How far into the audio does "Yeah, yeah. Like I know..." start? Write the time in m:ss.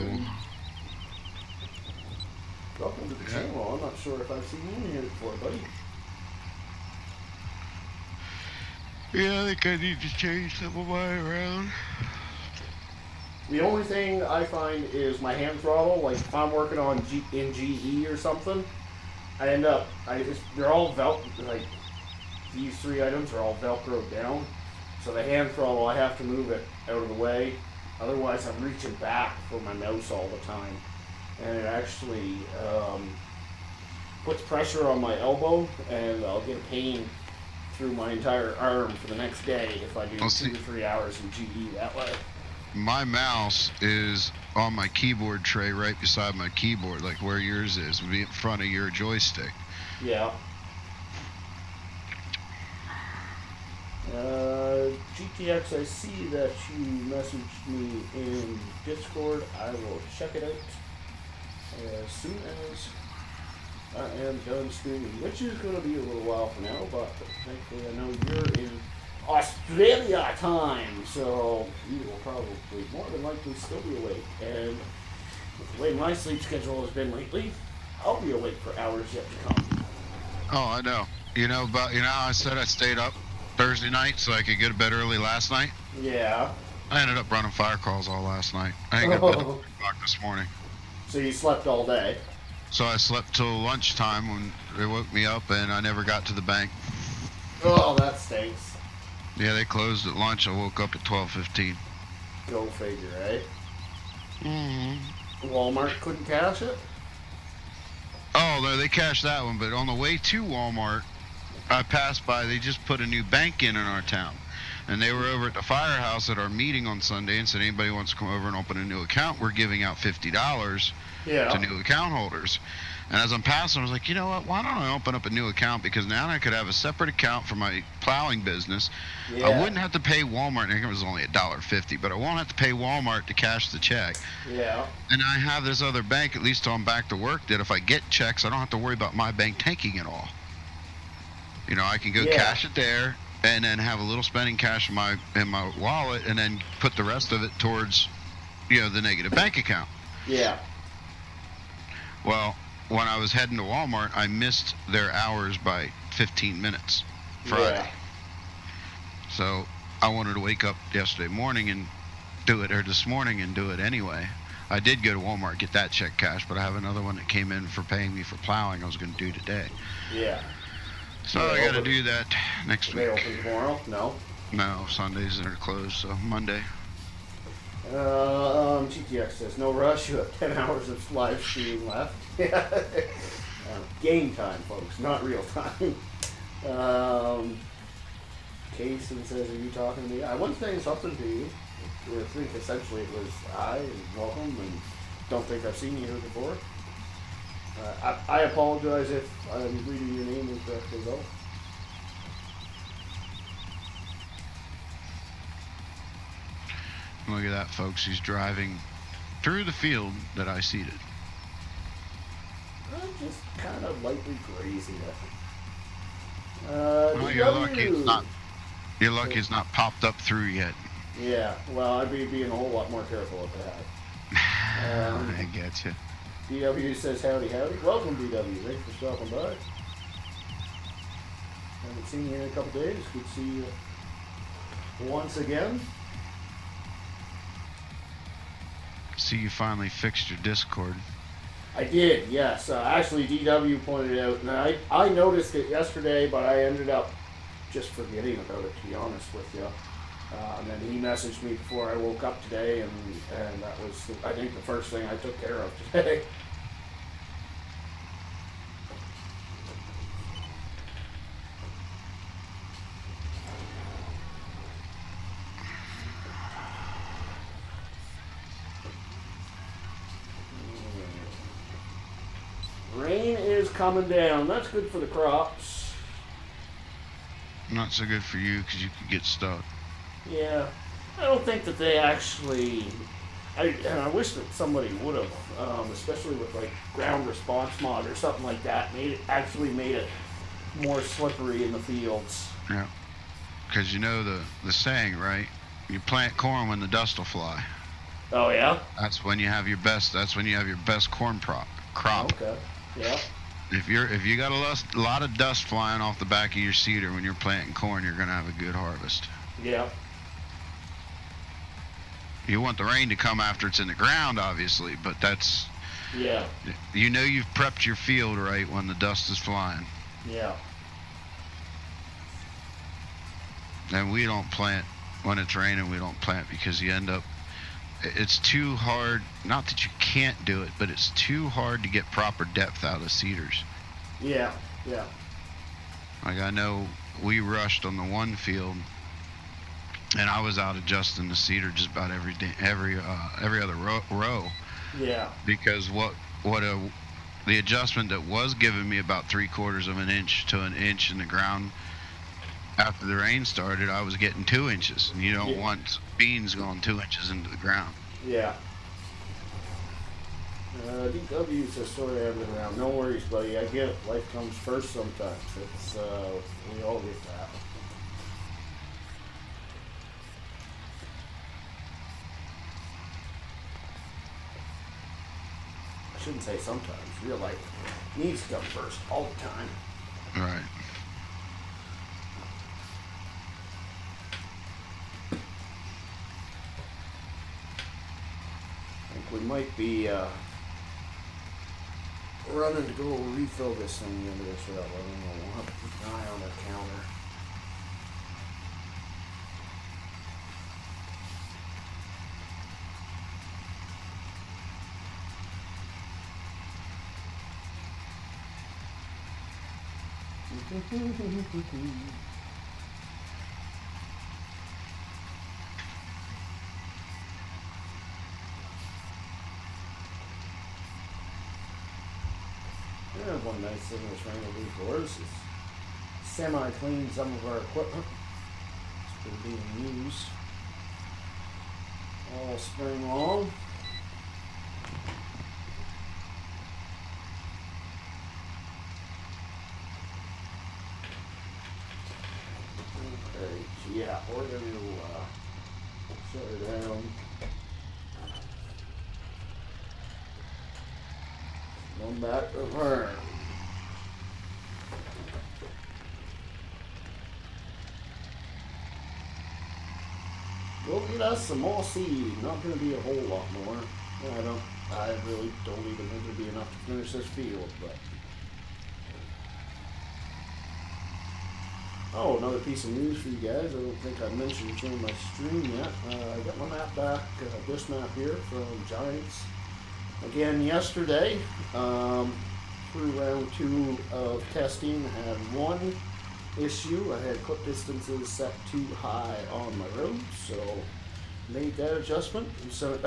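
5:34.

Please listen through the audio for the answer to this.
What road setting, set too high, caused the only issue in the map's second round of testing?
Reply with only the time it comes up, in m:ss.
8:07.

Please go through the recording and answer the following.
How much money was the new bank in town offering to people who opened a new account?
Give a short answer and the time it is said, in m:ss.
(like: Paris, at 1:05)
$50, at 1:59.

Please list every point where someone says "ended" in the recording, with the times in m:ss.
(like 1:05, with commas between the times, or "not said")
1:27, 4:06.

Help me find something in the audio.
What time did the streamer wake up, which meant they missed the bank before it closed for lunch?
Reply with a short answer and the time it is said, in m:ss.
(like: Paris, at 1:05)
12:15, at 1:41.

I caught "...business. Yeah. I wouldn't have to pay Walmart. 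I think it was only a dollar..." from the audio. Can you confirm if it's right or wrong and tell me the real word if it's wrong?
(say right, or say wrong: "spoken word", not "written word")
right.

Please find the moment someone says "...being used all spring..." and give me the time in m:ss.
7:09.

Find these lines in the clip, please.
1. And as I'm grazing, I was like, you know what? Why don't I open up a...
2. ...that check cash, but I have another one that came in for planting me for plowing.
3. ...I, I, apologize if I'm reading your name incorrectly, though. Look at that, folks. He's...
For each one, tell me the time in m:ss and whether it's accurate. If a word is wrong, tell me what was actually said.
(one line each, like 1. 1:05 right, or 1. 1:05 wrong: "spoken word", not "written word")
1. 2:03 wrong: "passing", not "grazing"
2. 2:45 wrong: "paying", not "planting"
3. 3:18 right.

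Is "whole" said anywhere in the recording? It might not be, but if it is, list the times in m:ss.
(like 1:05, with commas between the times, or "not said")
3:42, 7:43.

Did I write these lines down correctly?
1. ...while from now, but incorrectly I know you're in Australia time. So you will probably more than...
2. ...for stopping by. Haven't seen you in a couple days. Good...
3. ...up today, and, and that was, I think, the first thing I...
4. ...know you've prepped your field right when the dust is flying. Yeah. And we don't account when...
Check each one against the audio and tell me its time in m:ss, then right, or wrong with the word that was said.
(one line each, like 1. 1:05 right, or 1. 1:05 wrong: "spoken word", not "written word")
1. 1:06 wrong: "thankfully", not "incorrectly"
2. 3:48 right
3. 4:12 right
4. 5:17 wrong: "plant", not "account".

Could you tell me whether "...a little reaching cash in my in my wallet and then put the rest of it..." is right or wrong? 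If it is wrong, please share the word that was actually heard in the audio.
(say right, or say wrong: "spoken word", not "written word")
wrong: "spending", not "reaching".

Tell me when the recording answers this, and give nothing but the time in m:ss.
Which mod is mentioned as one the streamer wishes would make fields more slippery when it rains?
4:46.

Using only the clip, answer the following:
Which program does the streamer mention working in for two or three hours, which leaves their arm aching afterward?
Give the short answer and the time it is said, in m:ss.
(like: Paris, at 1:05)
GE, at 0:41.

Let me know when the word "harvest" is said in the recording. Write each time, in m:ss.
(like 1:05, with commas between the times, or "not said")
5:08.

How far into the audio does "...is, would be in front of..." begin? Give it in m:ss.
0:47.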